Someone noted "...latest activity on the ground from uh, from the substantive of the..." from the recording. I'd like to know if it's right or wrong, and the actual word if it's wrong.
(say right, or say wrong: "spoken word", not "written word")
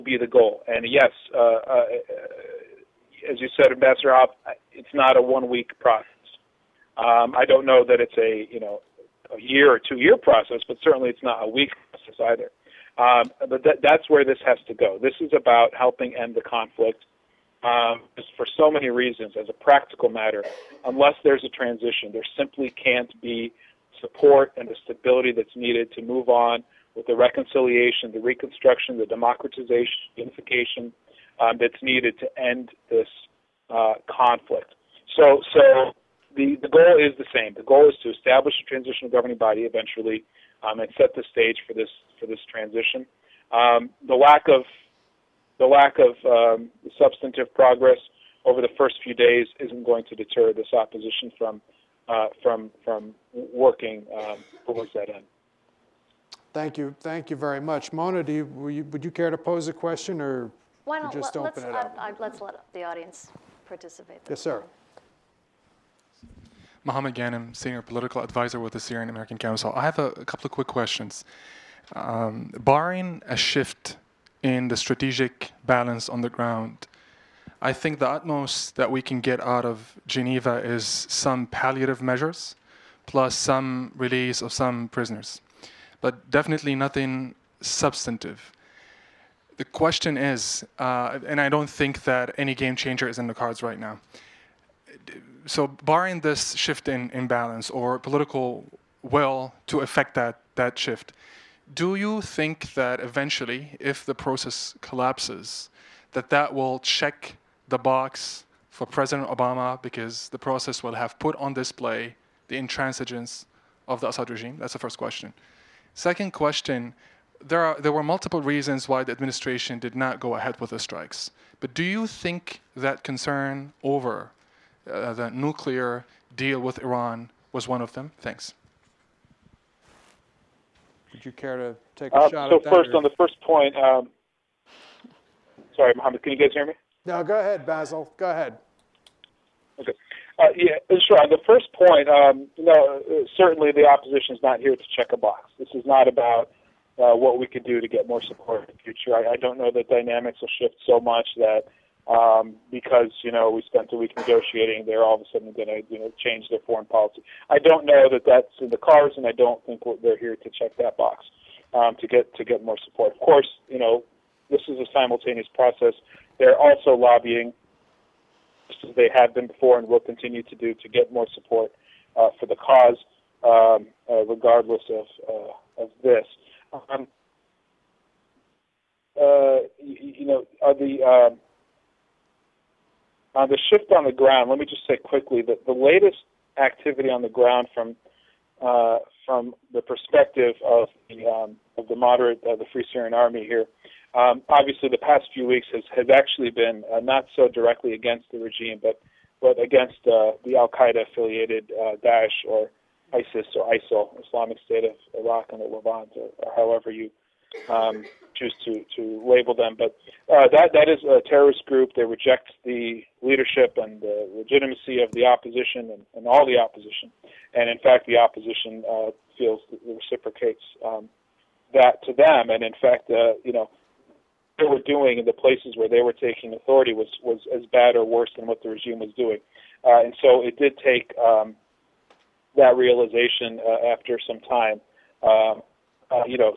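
wrong: "perspective", not "substantive".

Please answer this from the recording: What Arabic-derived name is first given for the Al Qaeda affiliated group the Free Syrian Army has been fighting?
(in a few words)
Daesh.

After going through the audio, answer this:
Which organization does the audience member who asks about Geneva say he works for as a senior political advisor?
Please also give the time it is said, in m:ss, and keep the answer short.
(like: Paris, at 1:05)
Syrian American Council, at 1:08.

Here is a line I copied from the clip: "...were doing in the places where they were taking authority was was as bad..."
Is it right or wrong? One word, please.
right.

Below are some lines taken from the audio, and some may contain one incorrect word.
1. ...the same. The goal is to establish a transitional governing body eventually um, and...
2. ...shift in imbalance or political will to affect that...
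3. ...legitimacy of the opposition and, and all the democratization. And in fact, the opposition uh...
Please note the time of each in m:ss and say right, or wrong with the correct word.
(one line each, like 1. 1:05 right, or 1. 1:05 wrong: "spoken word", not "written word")
1. 0:37 right
2. 1:36 right
3. 3:34 wrong: "opposition", not "democratization".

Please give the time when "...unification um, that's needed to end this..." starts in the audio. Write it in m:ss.
0:30.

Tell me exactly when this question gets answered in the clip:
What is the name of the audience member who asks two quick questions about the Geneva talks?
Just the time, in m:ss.
1:06.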